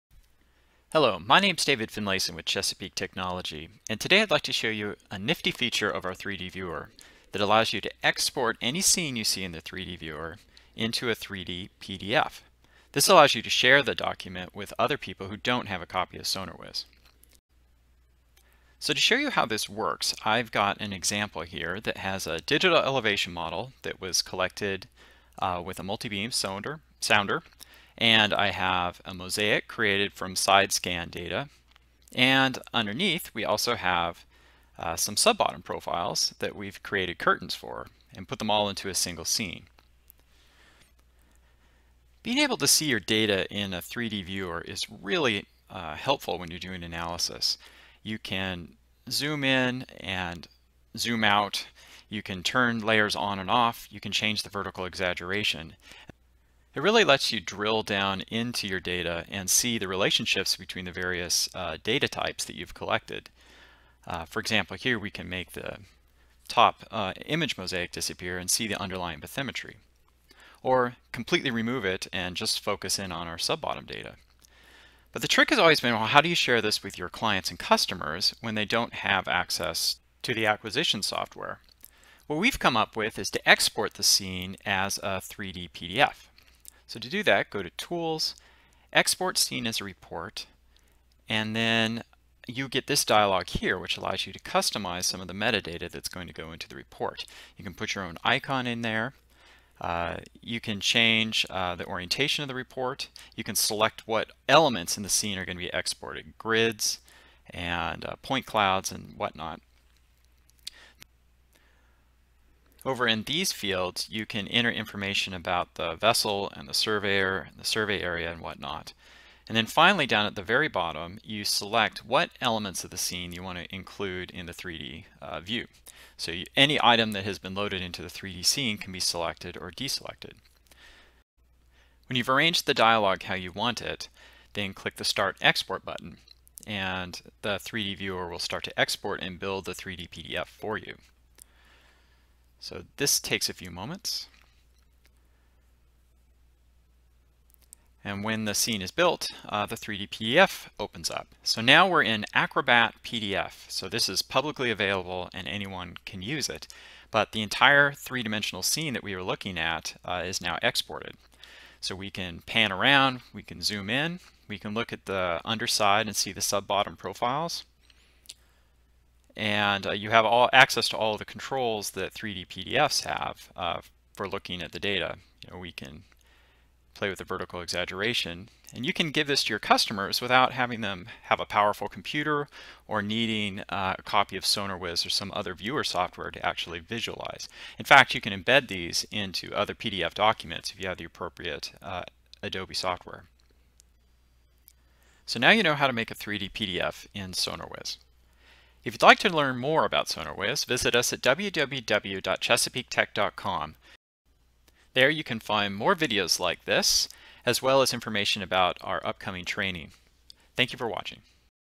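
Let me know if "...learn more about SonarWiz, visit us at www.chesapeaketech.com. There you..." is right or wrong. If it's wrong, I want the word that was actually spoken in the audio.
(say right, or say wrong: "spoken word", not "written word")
right.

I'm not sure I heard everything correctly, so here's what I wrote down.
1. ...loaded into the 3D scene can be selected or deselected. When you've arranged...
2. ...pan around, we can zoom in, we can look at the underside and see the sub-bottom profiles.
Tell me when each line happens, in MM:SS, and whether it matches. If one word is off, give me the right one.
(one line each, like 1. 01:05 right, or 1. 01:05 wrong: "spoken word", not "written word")
1. 02:07 right
2. 02:42 right.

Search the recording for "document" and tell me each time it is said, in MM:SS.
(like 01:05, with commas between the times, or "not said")
00:13, 03:10.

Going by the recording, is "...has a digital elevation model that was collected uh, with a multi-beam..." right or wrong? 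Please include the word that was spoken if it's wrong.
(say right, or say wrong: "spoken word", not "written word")
right.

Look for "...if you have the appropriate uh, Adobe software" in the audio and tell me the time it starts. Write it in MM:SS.
03:10.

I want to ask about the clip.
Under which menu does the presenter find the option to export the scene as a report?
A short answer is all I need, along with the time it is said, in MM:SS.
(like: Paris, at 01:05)
Tools, at 01:27.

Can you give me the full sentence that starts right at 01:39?
Uh, you can change uh, the orientation of the report.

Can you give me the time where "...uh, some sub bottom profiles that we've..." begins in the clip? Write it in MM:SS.
00:34.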